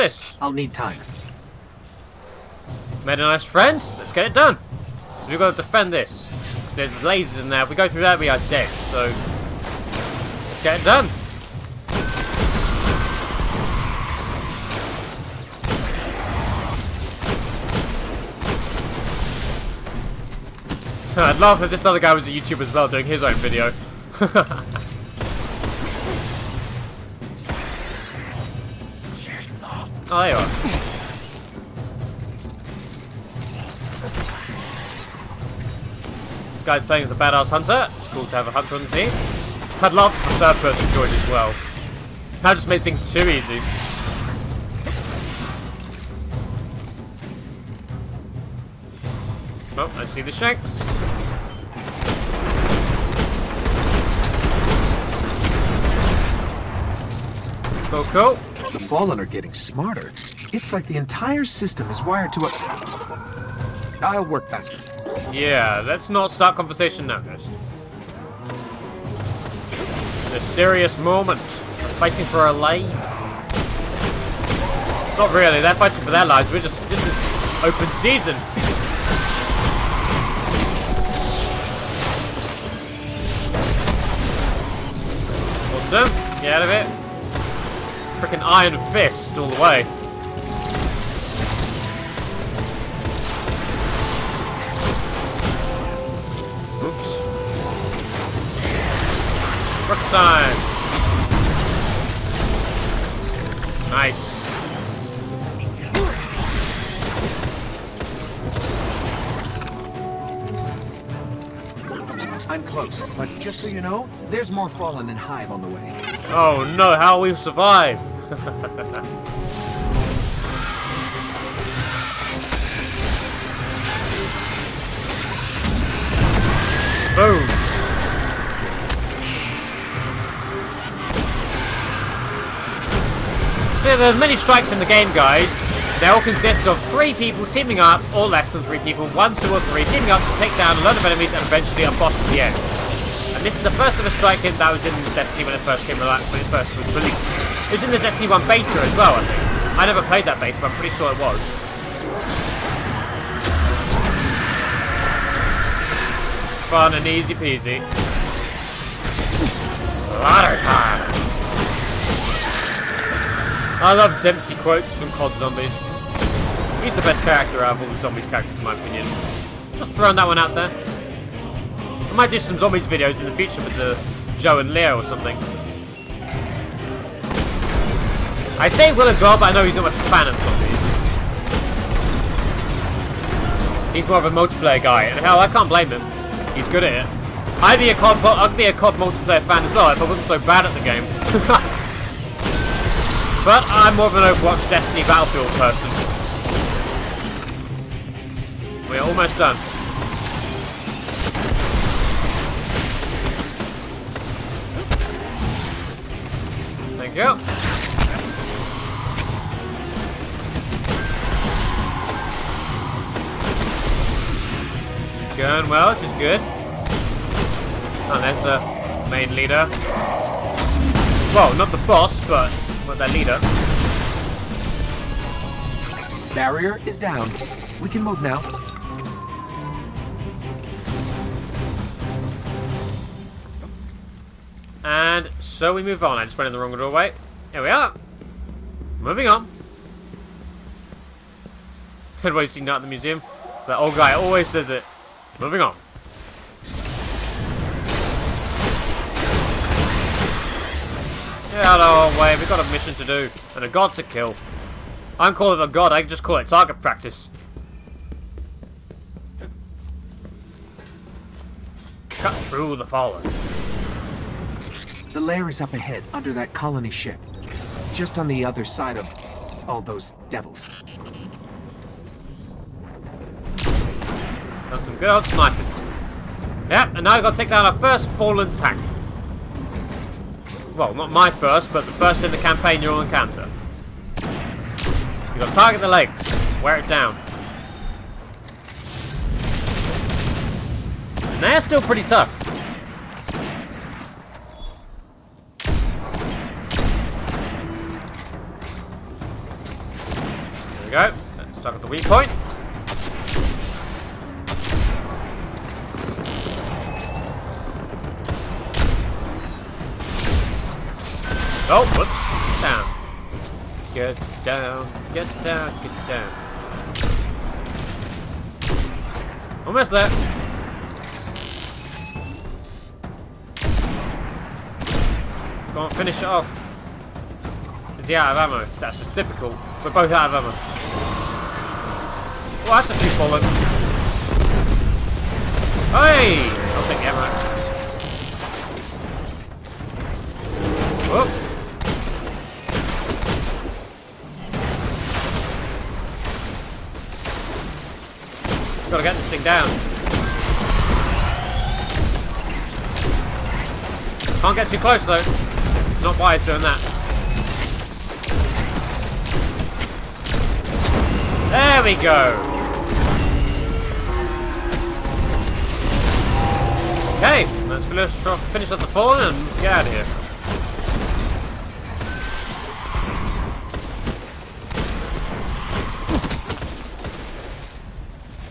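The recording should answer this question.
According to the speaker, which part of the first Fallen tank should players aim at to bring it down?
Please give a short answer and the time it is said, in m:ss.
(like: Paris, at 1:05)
the legs, at 4:45.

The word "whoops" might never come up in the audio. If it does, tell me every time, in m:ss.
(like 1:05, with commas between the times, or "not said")
5:11.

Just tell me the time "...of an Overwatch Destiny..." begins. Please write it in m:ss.
3:14.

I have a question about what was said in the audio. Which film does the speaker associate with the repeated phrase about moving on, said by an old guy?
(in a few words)
Night at the Museum.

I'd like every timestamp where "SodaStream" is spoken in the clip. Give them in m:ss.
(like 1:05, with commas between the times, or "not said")
not said.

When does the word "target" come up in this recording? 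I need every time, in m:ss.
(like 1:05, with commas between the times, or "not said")
4:16, 4:45, 5:01.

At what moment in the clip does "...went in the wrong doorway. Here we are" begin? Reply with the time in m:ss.
3:56.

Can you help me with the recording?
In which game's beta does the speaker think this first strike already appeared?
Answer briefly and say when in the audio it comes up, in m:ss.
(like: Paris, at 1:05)
Destiny 1, at 2:27.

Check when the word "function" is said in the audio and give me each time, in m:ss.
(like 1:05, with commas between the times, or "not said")
not said.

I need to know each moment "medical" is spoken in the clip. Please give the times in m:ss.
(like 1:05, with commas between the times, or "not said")
not said.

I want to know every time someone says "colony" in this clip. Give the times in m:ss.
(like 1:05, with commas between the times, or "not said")
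4:26.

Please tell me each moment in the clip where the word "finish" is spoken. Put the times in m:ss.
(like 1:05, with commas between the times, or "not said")
5:25, 6:07.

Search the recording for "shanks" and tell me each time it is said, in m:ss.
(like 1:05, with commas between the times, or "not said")
0:50.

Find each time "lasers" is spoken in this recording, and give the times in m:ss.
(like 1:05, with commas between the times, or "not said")
0:06.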